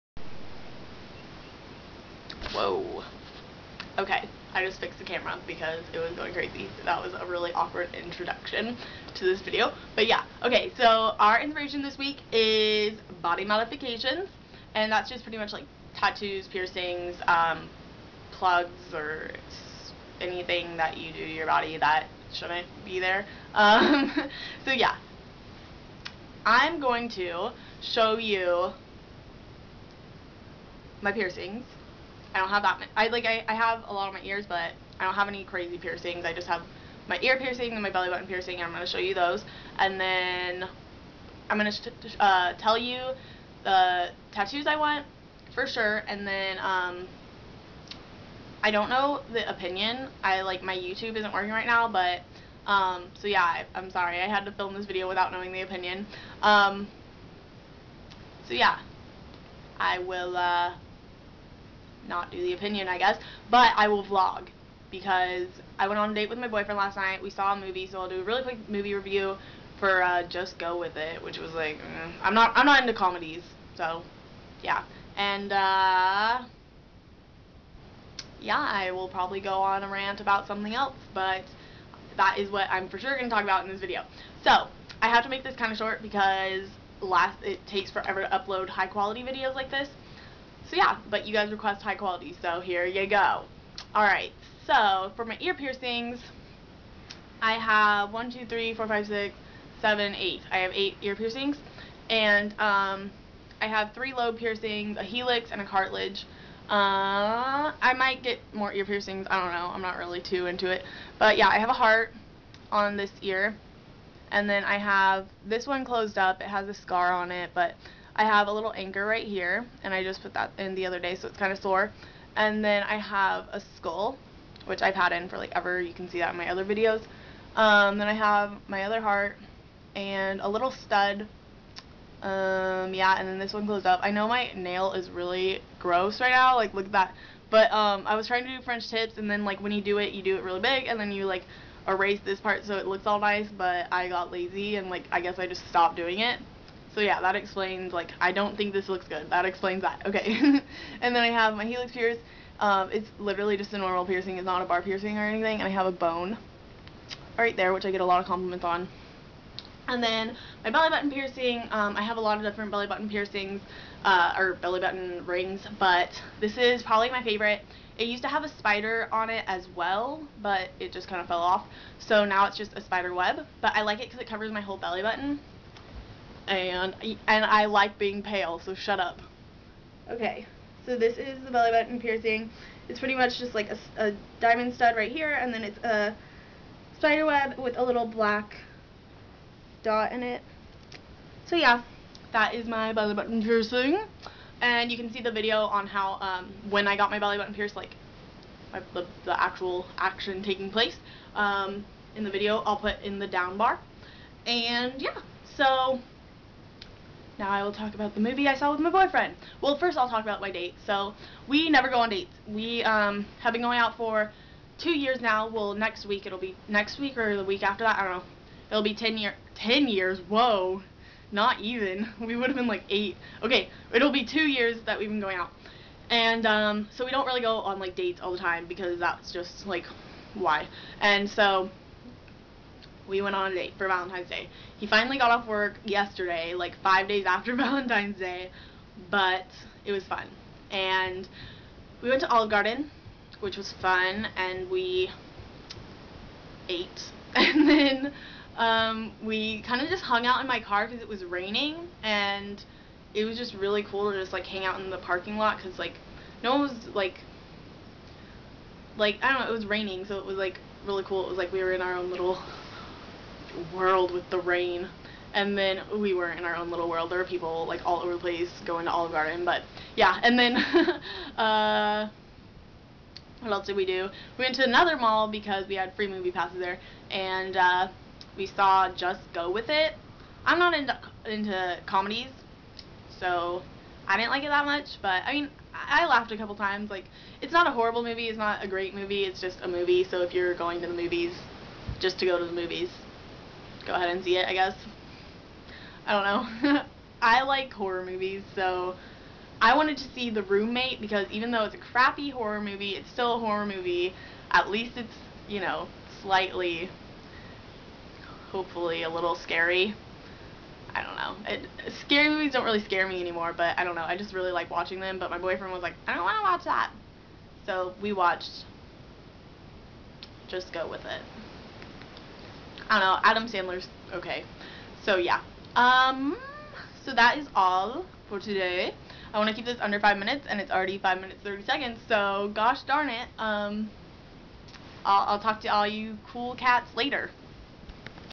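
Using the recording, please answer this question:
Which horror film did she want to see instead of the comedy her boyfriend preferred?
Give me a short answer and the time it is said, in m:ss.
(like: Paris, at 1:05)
The Roommate, at 5:00.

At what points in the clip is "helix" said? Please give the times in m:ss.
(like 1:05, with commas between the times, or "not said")
1:45, 2:31.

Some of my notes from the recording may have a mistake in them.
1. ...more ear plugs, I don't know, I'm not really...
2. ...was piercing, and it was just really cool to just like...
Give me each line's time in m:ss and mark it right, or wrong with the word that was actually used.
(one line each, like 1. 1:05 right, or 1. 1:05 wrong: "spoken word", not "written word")
1. 1:48 wrong: "piercings", not "plugs"
2. 4:11 wrong: "raining", not "piercing".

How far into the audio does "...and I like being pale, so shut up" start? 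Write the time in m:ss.
2:57.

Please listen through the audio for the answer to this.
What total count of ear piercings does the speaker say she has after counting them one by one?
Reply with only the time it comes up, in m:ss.
1:40.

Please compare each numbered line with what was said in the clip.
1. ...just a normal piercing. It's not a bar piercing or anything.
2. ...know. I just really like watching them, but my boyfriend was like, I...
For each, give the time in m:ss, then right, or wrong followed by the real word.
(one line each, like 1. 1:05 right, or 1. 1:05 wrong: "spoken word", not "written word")
1. 2:33 right
2. 5:13 right.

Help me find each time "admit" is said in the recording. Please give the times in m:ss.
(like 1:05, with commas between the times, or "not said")
not said.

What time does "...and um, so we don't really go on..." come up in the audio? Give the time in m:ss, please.
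3:46.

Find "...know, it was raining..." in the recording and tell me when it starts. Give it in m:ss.
4:19.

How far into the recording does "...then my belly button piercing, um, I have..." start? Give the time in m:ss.
2:40.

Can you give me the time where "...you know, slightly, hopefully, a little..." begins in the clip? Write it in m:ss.
5:05.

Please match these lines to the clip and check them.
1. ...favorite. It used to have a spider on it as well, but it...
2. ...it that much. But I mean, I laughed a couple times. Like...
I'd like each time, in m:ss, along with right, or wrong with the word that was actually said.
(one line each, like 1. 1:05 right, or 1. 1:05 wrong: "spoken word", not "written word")
1. 2:47 right
2. 4:44 right.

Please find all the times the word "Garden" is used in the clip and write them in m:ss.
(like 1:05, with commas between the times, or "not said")
4:02, 4:29.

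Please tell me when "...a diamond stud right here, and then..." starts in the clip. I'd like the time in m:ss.
3:03.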